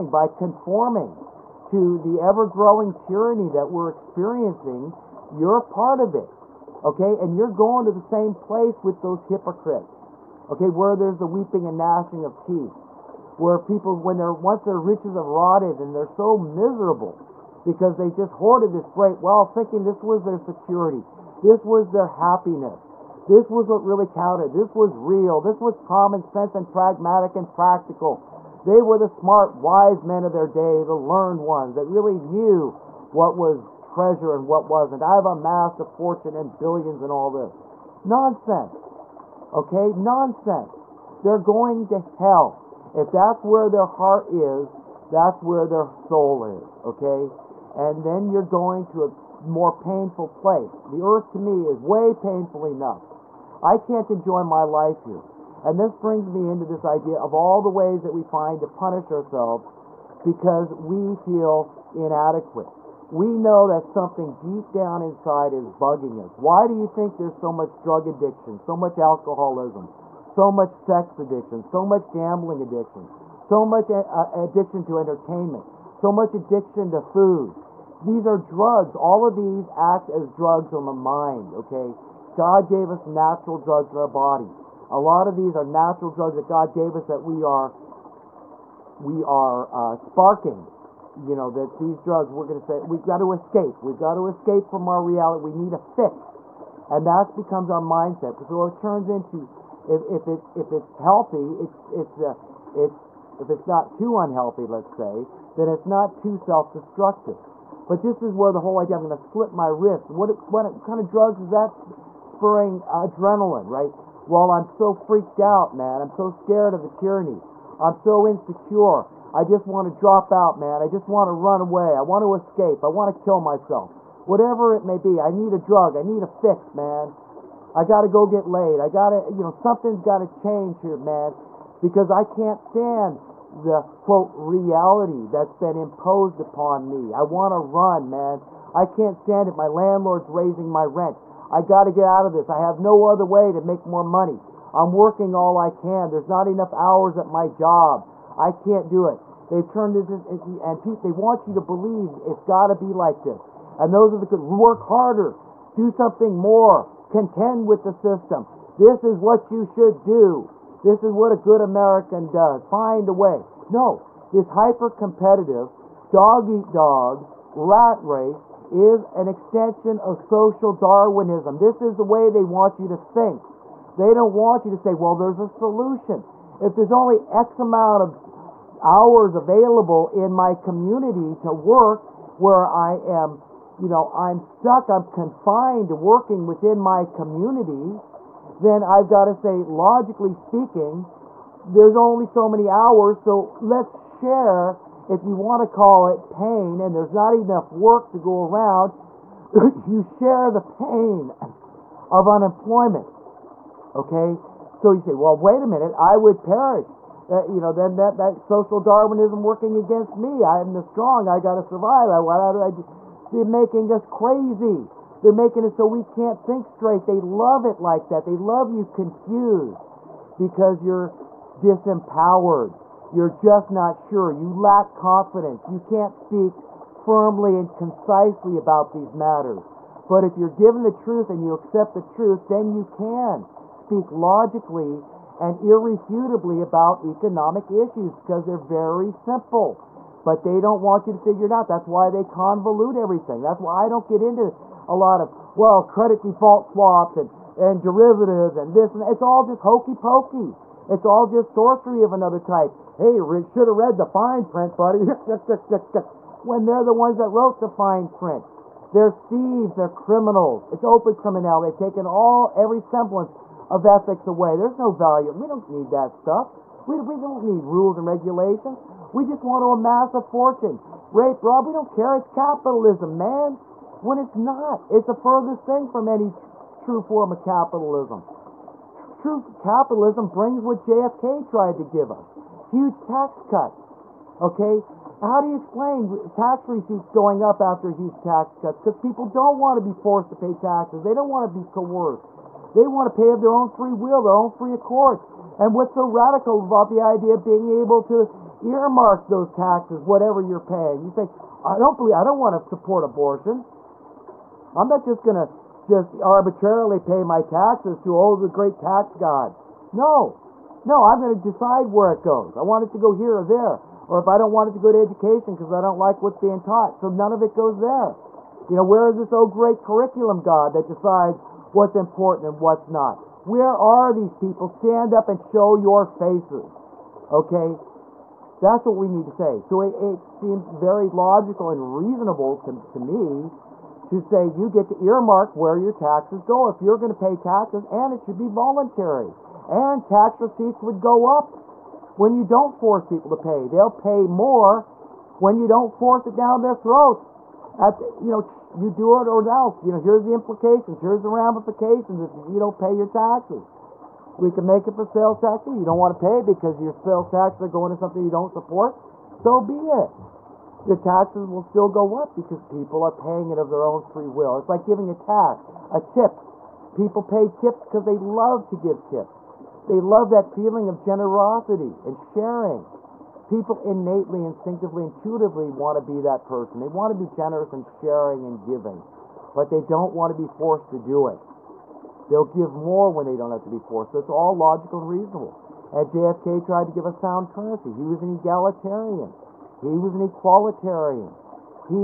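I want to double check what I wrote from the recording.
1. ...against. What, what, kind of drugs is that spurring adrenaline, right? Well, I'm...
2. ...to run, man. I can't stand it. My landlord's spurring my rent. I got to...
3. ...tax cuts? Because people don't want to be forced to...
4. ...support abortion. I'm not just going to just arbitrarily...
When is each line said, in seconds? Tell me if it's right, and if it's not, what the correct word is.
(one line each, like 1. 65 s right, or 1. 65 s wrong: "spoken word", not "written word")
1. 109 s wrong: "wrist", not "against"
2. 137 s wrong: "raising", not "spurring"
3. 288 s right
4. 302 s right.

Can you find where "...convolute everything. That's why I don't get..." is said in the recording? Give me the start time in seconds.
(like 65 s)
242 s.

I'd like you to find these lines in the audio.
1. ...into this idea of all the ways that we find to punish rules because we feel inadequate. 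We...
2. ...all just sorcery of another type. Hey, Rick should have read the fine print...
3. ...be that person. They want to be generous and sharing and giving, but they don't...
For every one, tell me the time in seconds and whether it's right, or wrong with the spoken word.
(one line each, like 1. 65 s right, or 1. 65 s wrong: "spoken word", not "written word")
1. 56 s wrong: "ourselves", not "rules"
2. 251 s right
3. 376 s right.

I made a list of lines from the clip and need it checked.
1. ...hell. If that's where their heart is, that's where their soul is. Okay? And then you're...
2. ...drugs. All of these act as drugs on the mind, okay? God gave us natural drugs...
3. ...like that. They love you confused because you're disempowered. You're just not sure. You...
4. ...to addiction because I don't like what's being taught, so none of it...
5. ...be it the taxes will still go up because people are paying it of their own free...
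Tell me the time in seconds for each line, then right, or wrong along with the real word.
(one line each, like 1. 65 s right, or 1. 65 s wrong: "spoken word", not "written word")
1. 41 s right
2. 78 s right
3. 217 s right
4. 314 s wrong: "education", not "addiction"
5. 359 s right.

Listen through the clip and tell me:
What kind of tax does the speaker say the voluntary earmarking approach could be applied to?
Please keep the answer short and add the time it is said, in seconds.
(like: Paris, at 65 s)
Sales tax, at 355 s.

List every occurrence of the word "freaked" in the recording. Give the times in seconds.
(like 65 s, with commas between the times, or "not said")
114 s.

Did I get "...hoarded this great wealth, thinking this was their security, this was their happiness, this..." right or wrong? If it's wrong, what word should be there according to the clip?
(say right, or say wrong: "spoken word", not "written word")
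right.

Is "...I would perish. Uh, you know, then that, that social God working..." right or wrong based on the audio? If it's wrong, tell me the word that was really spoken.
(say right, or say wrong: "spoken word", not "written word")
wrong: "Darwinism", not "God".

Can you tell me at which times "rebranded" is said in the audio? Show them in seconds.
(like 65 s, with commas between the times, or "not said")
not said.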